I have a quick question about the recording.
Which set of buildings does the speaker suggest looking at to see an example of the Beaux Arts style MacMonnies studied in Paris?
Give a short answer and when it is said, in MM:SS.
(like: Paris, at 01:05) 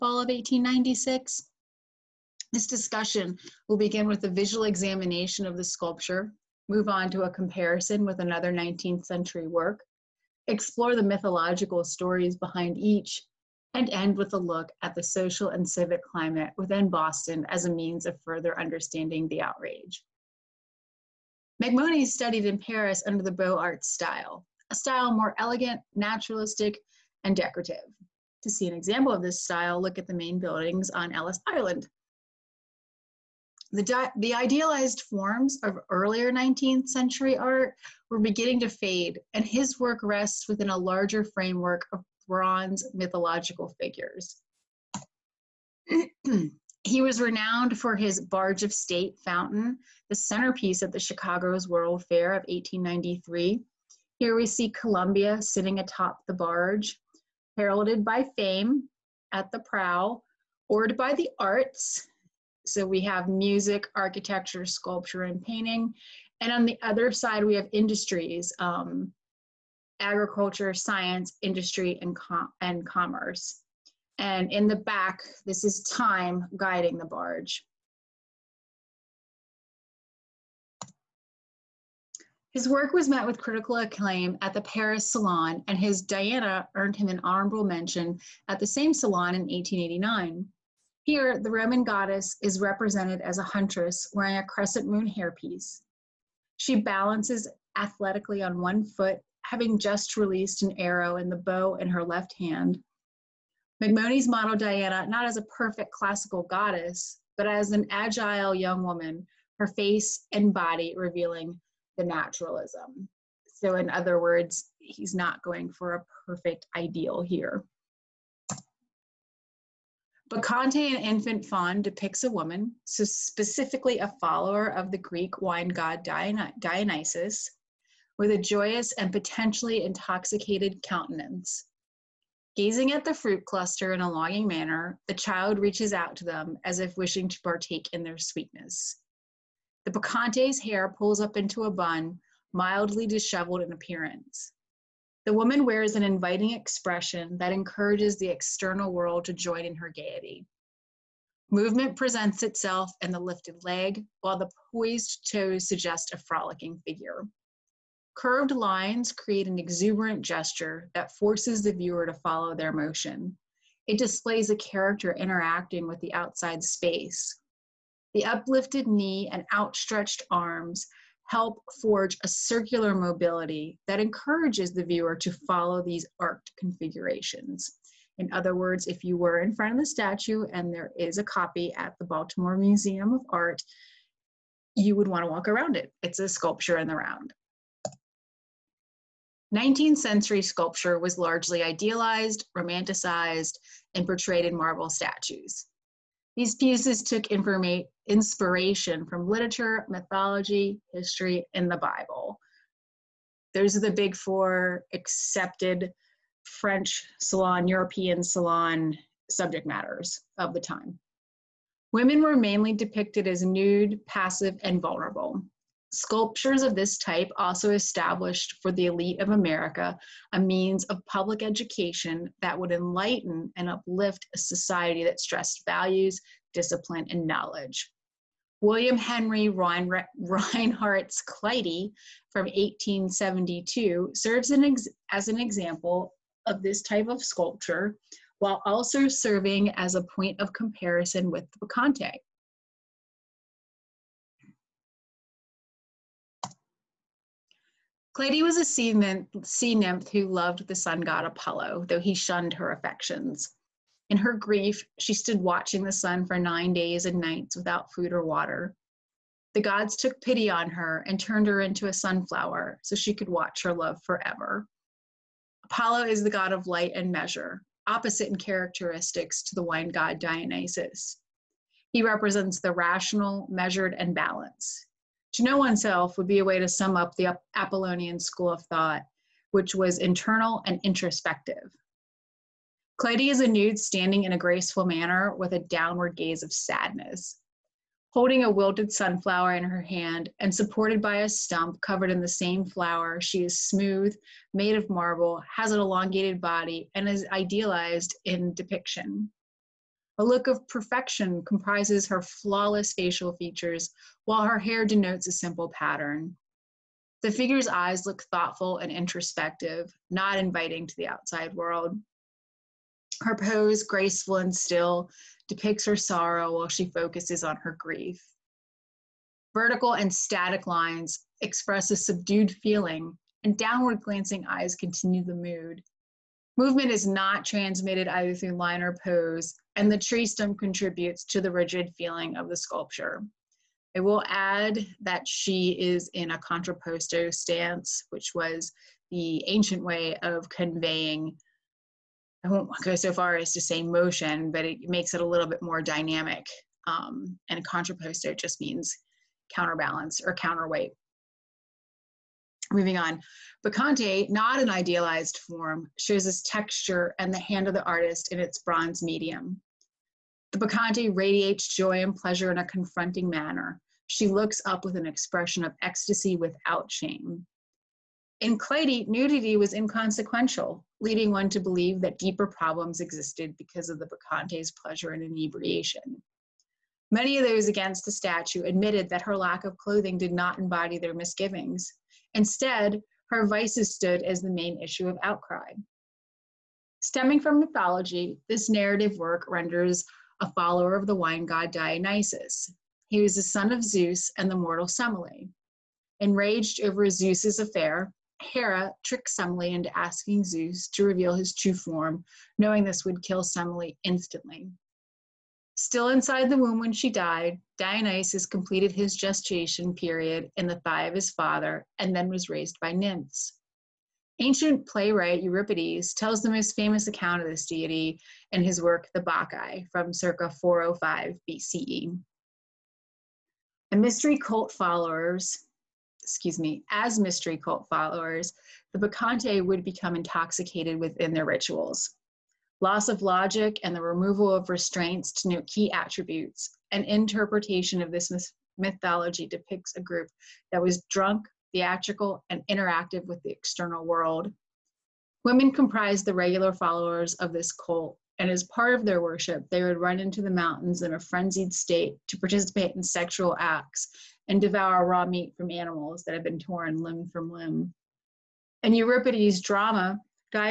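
Ellis Island, at 00:31.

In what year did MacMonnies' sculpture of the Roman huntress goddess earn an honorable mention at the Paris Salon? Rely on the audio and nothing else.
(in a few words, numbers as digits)
1889.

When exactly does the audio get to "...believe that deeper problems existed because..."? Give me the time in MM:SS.
06:11.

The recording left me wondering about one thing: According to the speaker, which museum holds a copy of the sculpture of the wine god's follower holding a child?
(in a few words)
Baltimore Museum of Art.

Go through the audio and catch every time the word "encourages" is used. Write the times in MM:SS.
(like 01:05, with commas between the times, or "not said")
02:27, 02:54.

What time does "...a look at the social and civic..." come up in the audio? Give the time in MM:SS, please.
00:14.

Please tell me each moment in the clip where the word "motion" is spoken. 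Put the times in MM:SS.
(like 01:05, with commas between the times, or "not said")
02:42, 05:43.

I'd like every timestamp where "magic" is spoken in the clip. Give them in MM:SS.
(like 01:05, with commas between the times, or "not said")
not said.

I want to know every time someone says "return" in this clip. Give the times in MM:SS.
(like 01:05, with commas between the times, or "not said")
not said.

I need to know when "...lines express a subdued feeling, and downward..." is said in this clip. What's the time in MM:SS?
05:20.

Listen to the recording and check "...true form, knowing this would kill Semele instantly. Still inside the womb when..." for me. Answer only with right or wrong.
right.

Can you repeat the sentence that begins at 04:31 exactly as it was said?
He represents the rational, measured, and balanced.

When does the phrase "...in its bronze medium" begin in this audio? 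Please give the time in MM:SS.
05:58.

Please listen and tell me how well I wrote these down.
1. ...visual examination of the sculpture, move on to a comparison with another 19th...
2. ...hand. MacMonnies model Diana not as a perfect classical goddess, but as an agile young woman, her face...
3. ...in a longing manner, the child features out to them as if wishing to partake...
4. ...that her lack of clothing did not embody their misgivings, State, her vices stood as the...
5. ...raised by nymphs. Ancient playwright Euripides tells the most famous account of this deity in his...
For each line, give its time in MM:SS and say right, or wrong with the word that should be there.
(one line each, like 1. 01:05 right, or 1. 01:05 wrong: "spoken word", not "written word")
1. 00:04 right
2. 01:42 right
3. 02:13 wrong: "reaches", not "features"
4. 06:19 wrong: "Instead", not "State"
5. 06:52 right.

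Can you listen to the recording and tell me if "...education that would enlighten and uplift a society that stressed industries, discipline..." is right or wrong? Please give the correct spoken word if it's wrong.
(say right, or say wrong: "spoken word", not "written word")
wrong: "values", not "industries".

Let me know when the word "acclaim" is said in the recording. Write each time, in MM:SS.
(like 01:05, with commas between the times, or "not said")
01:23.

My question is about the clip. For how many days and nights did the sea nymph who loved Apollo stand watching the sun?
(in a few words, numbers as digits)
9.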